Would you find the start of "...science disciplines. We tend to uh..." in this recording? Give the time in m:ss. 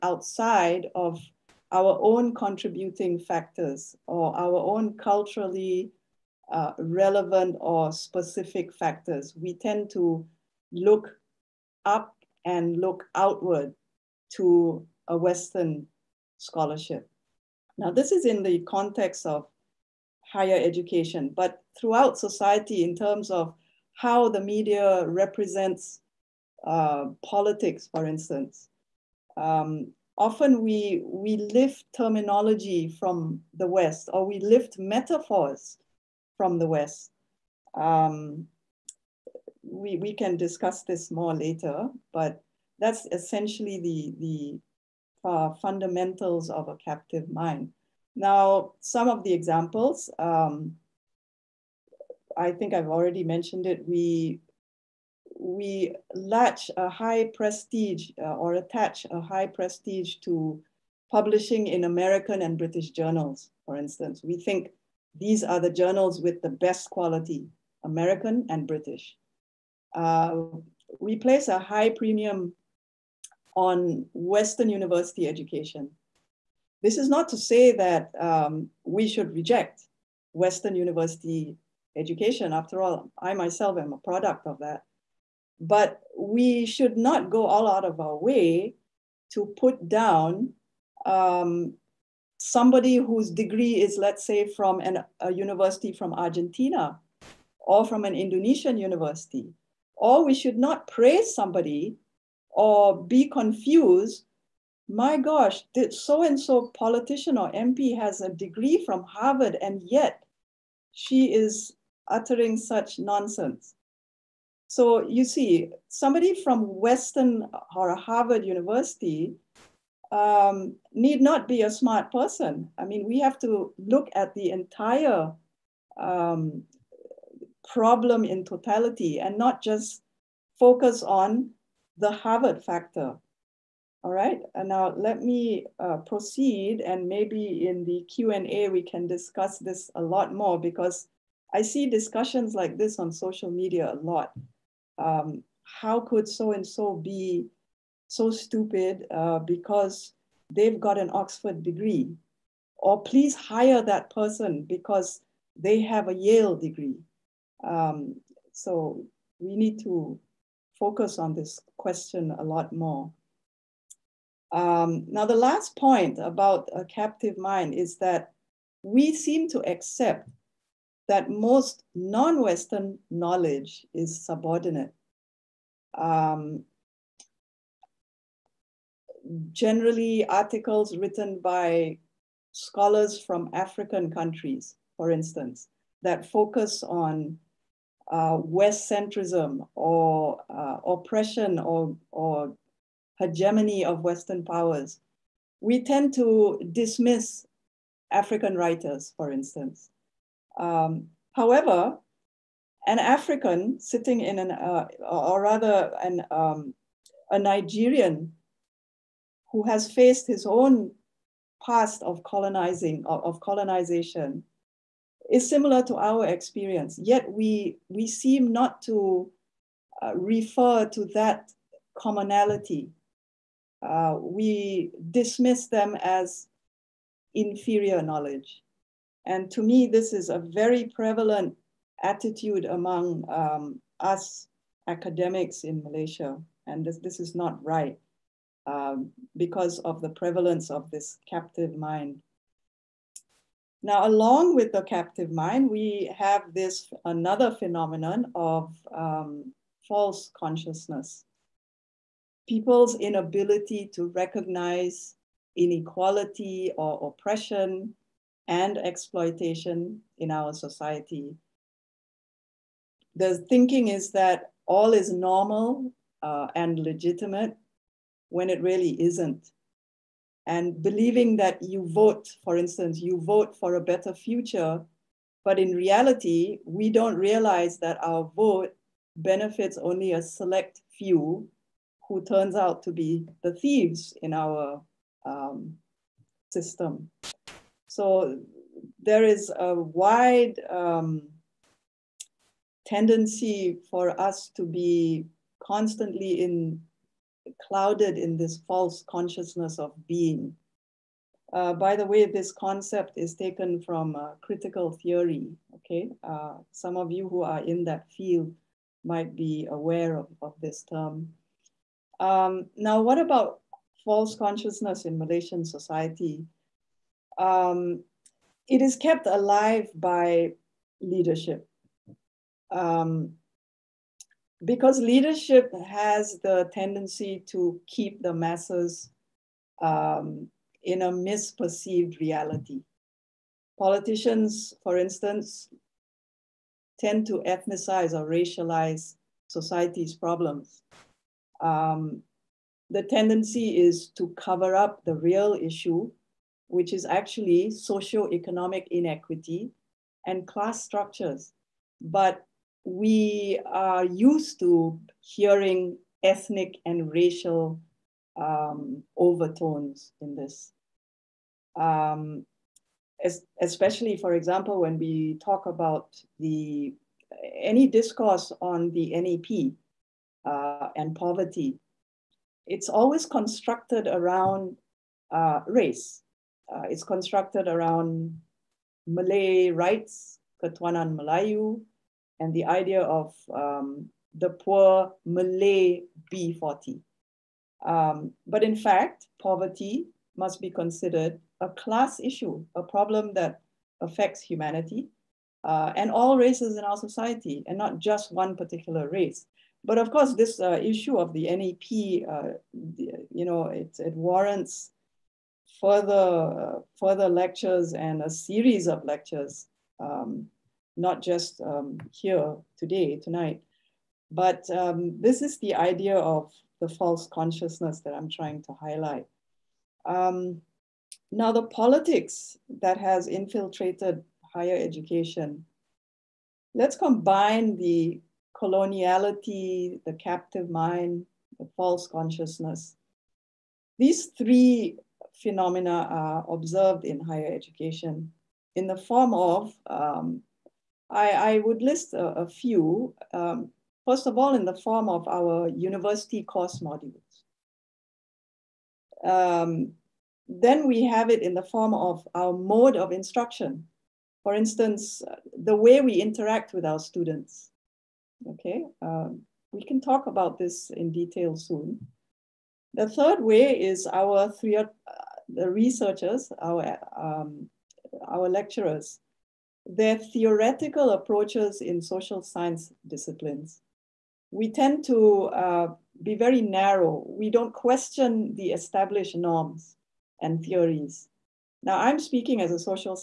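7:52.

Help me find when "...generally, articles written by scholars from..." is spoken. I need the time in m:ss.
2:59.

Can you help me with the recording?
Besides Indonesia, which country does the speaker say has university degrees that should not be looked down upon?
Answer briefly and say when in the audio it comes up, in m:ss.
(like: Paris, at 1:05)
Argentina, at 1:36.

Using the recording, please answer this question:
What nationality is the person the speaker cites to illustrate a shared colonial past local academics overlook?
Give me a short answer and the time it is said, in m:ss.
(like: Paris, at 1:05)
Nigerian, at 3:27.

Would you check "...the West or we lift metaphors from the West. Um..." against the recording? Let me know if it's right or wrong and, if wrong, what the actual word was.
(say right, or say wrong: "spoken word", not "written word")
right.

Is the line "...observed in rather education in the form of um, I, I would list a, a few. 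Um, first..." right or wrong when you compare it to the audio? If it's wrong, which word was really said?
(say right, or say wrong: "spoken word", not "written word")
wrong: "higher", not "rather".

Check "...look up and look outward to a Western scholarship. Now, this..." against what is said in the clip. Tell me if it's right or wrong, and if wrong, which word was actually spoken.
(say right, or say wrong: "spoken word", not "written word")
right.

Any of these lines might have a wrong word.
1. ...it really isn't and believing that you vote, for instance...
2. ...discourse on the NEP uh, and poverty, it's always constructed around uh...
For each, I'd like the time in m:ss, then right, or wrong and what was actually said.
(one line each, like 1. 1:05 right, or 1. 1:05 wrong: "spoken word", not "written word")
1. 4:28 right
2. 6:07 right.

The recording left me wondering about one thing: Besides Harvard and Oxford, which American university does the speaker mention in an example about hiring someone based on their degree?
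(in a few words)
Yale.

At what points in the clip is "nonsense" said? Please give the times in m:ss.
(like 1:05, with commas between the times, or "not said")
1:52.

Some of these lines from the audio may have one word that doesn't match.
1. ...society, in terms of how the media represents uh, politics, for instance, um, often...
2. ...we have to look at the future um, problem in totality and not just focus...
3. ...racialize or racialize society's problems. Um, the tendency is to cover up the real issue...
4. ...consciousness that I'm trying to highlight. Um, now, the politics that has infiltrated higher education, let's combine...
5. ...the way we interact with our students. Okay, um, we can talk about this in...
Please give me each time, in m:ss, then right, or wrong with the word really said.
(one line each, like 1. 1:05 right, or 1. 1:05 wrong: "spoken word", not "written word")
1. 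0:22 right
2. 2:03 wrong: "entire", not "future"
3. 5:37 wrong: "ethnicize", not "racialize"
4. 6:57 right
5. 7:35 right.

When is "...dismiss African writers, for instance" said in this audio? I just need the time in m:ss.
3:16.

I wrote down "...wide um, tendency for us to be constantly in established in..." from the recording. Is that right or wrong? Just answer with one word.
wrong.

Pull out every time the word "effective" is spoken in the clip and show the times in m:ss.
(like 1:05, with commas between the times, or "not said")
not said.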